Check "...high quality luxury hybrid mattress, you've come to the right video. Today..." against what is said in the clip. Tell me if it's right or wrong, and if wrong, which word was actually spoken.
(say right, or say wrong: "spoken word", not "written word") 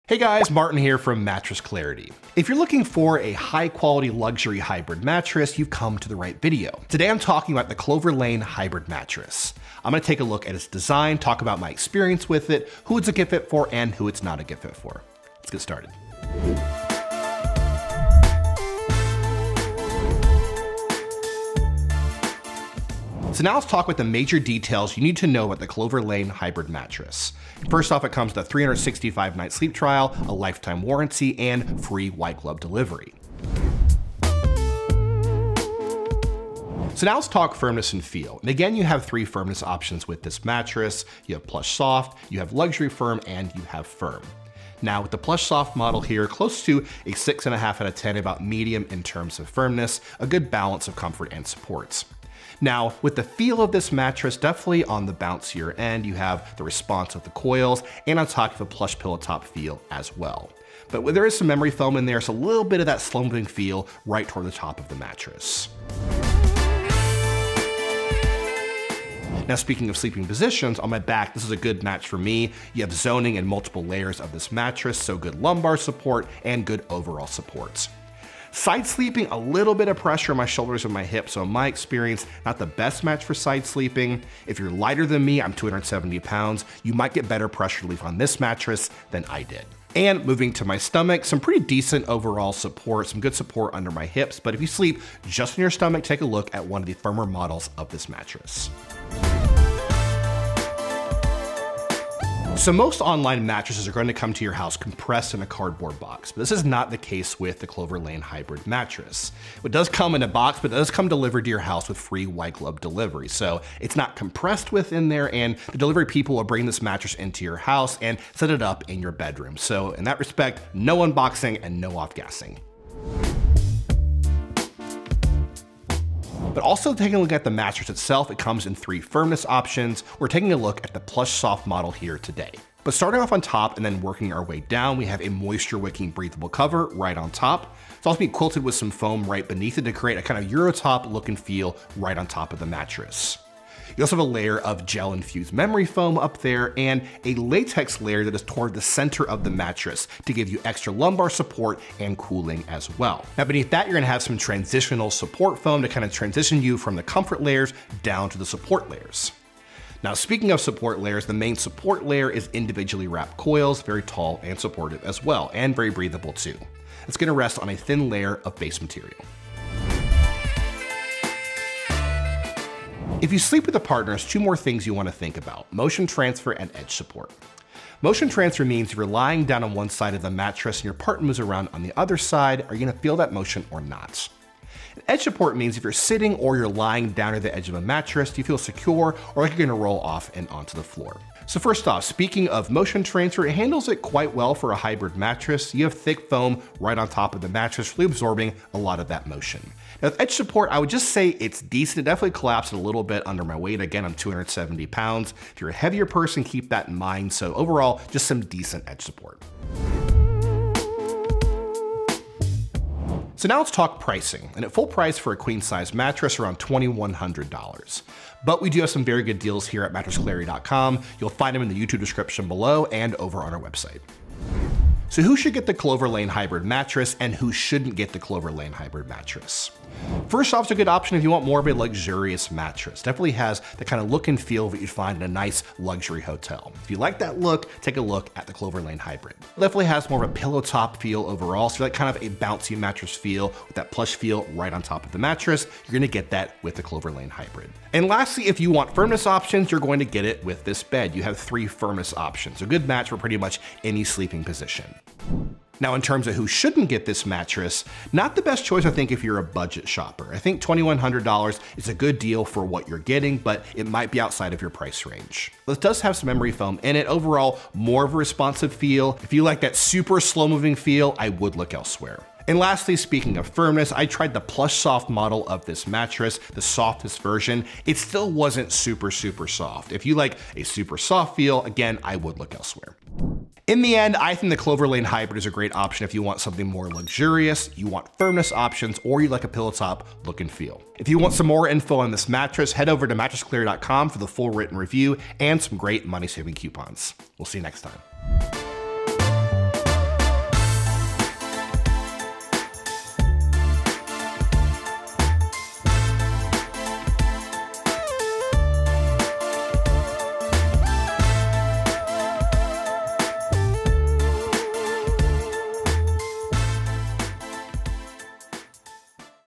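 right.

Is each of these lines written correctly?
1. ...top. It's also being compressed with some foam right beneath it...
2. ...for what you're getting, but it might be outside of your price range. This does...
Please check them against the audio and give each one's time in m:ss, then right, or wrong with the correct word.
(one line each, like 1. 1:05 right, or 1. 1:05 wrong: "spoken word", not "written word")
1. 2:17 wrong: "quilted", not "compressed"
2. 4:22 right.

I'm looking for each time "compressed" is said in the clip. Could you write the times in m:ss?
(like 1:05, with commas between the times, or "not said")
1:44, 1:54.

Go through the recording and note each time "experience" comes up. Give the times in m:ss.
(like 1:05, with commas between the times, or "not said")
0:11, 1:21.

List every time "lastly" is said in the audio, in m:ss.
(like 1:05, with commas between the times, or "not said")
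4:08, 4:32.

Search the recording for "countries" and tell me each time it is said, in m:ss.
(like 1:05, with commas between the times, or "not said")
not said.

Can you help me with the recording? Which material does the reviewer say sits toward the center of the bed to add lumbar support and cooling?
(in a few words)
Latex.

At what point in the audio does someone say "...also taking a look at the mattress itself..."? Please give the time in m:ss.
2:06.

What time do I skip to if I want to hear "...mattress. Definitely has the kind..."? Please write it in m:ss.
3:52.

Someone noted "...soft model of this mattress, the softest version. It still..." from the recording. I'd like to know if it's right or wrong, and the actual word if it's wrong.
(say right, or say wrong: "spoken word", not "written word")
right.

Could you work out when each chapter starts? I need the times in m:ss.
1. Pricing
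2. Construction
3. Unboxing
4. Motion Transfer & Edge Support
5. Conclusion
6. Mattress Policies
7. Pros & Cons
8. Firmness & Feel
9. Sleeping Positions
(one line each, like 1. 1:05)
1. 3:30
2. 2:03
3. 1:39
4. 2:50
5. 4:45
6. 0:20
7. 3:45
8. 0:34
9. 1:06.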